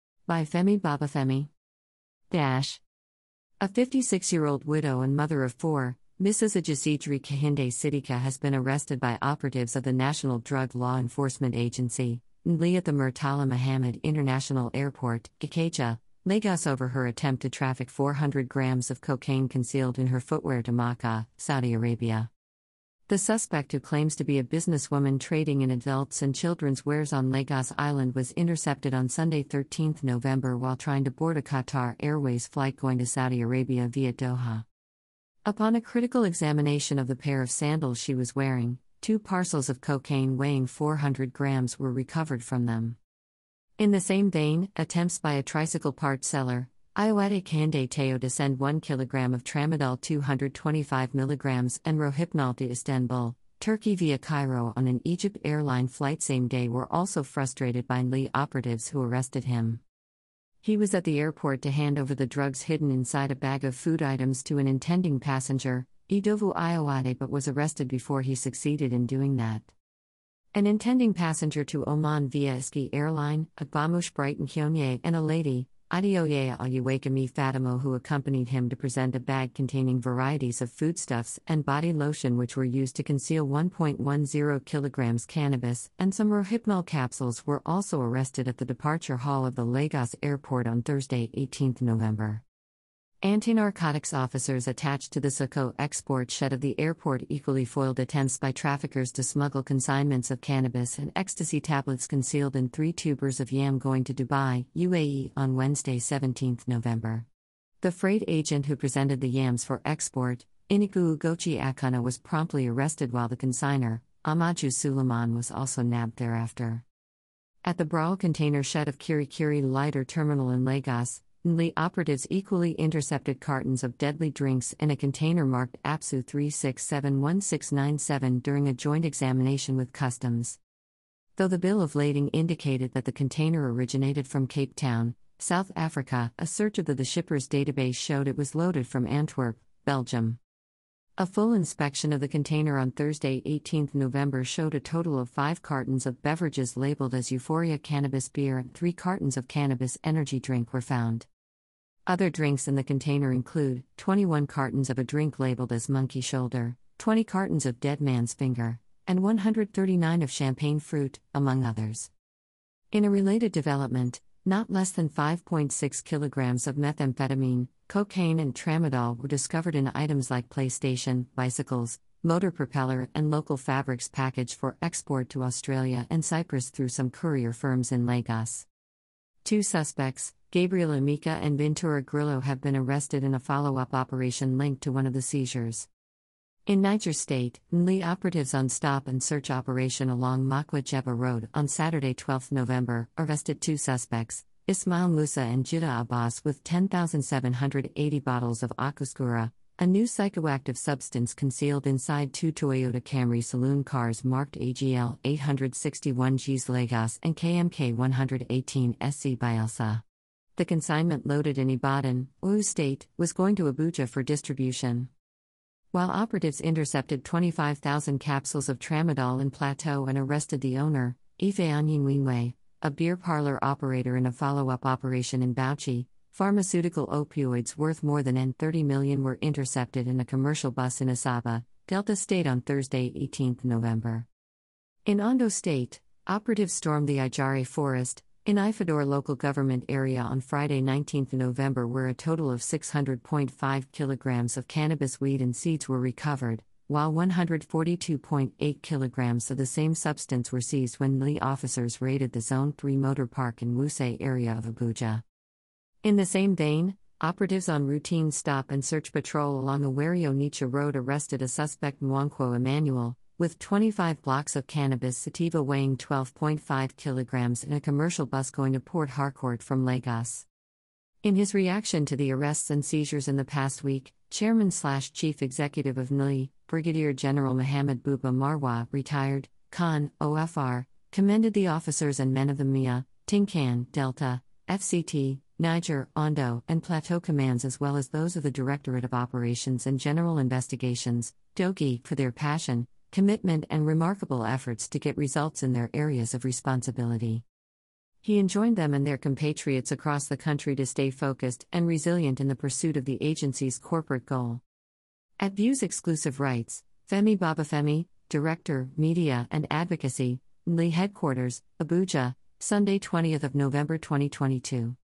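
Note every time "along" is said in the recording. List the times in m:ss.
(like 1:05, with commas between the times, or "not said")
3:10, 4:19.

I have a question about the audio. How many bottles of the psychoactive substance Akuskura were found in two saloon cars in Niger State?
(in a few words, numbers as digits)
10,780.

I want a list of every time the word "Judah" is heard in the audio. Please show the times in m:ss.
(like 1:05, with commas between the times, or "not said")
3:15.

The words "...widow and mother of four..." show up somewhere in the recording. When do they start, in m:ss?
0:04.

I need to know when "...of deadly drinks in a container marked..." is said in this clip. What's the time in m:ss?
2:03.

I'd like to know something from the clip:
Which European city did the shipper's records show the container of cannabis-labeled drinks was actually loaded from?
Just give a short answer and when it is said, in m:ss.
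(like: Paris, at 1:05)
Antwerp, at 2:19.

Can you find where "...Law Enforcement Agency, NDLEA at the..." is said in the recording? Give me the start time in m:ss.
0:10.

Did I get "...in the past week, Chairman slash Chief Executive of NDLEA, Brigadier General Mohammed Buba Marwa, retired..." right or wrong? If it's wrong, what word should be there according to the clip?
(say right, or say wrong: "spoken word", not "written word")
right.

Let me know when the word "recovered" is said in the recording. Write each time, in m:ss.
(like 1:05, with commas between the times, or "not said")
0:41, 4:05.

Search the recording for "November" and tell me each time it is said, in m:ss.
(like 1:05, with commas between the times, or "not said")
0:30, 1:31, 1:46, 2:23, 3:12, 3:53, 4:01, 5:13.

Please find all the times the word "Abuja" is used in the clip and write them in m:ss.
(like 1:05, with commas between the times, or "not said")
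3:33, 4:14, 5:11.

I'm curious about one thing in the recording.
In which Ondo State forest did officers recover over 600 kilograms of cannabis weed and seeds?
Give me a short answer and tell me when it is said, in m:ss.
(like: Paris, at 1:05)
Ajari forest, at 3:57.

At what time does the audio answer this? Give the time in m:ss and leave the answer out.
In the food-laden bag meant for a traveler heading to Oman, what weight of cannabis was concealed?
1:23.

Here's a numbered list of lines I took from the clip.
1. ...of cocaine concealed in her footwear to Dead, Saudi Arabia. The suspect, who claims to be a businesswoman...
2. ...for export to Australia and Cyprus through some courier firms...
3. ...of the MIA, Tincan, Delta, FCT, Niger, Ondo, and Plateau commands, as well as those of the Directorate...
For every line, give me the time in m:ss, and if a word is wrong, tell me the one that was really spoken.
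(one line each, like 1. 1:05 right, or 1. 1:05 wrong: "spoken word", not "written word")
1. 0:18 wrong: "Makkah", not "Dead"
2. 2:54 right
3. 4:42 right.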